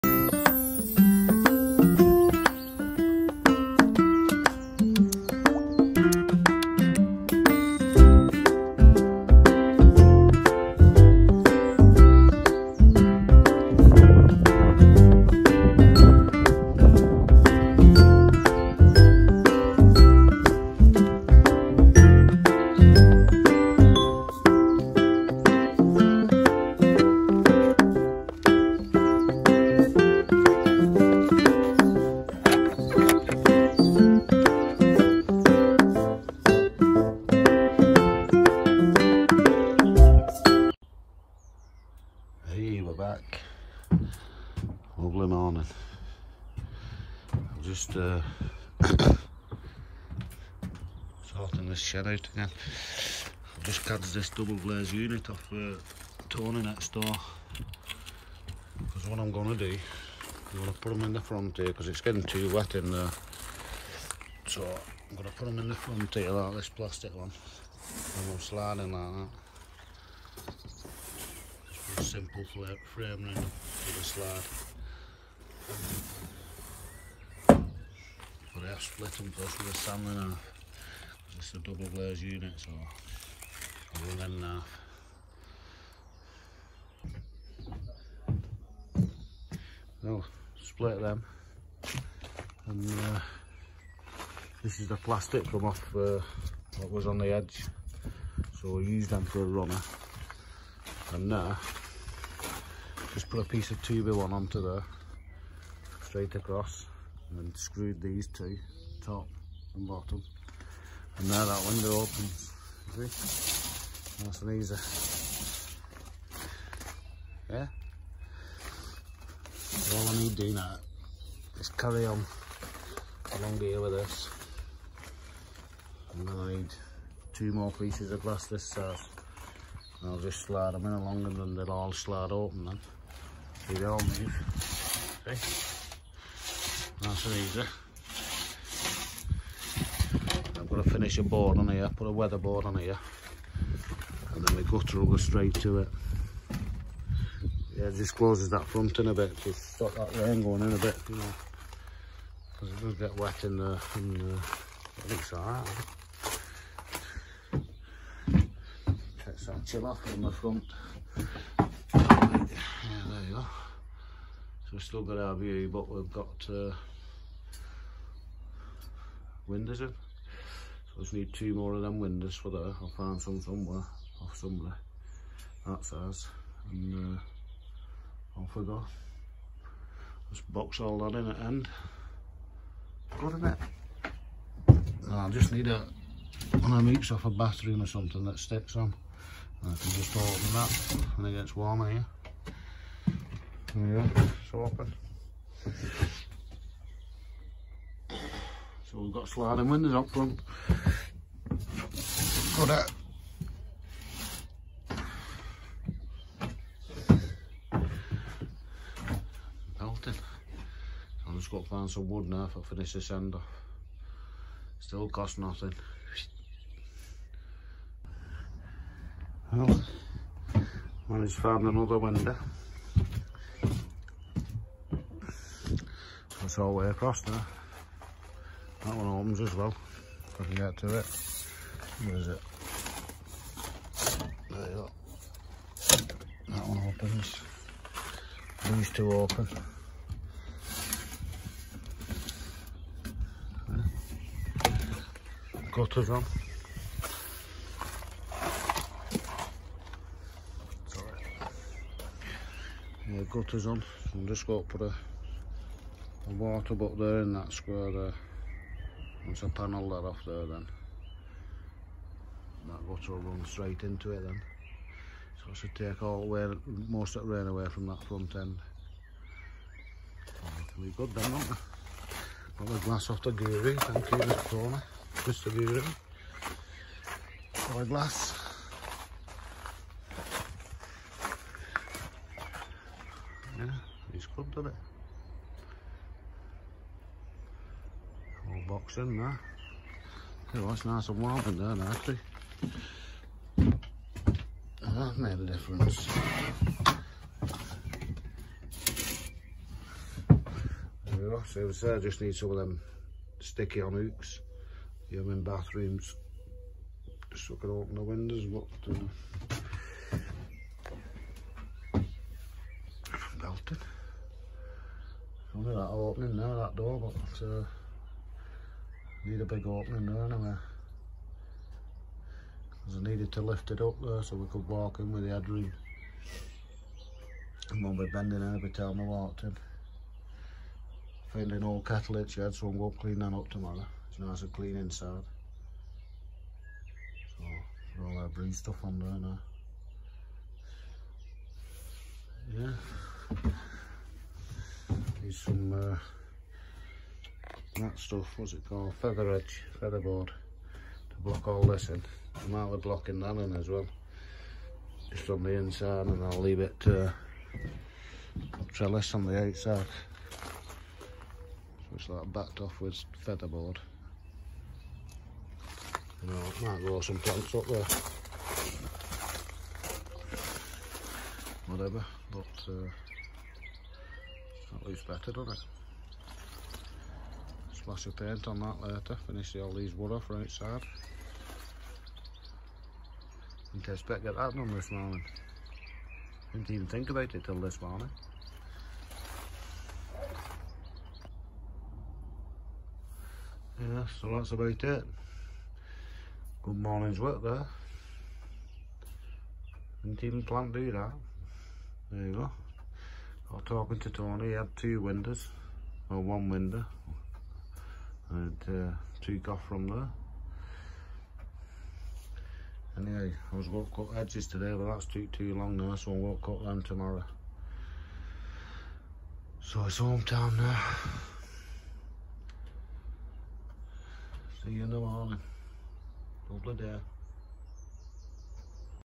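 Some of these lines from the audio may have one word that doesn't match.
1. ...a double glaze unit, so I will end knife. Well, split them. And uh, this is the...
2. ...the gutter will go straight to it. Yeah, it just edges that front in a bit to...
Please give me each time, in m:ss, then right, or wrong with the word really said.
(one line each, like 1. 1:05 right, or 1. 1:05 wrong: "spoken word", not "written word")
1. 1:21 right
2. 2:24 wrong: "closes", not "edges".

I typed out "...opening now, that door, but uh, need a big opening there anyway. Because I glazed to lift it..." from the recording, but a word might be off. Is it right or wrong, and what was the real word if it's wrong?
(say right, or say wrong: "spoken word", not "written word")
wrong: "needed", not "glazed".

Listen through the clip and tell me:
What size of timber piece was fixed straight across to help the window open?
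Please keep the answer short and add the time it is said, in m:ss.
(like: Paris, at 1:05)
2 by one, at 1:43.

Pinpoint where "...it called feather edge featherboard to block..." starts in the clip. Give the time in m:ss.
5:48.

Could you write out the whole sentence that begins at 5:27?
And won't be bending every time I walked in.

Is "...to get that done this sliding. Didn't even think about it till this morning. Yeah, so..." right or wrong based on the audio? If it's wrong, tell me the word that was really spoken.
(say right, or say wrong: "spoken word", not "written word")
wrong: "morning", not "sliding".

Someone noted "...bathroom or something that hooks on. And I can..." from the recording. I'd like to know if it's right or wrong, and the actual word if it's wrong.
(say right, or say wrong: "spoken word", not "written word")
wrong: "sticks", not "hooks".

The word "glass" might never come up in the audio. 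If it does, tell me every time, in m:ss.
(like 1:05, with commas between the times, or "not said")
2:08, 4:32, 4:37.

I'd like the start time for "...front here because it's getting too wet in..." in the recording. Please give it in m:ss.
1:01.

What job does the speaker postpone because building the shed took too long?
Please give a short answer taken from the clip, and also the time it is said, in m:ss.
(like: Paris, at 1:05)
cut edges, at 6:53.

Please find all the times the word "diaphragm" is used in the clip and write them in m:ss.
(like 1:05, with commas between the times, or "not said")
not said.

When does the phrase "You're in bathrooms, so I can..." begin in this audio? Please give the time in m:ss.
5:05.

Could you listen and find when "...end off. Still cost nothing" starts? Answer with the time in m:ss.
3:33.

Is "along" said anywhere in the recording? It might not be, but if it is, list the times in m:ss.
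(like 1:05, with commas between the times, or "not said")
2:03, 2:10.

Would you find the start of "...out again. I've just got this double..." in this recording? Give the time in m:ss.
0:52.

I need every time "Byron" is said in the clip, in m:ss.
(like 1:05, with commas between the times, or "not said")
not said.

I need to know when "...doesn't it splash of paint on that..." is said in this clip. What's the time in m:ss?
6:15.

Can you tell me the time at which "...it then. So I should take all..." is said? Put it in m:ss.
4:24.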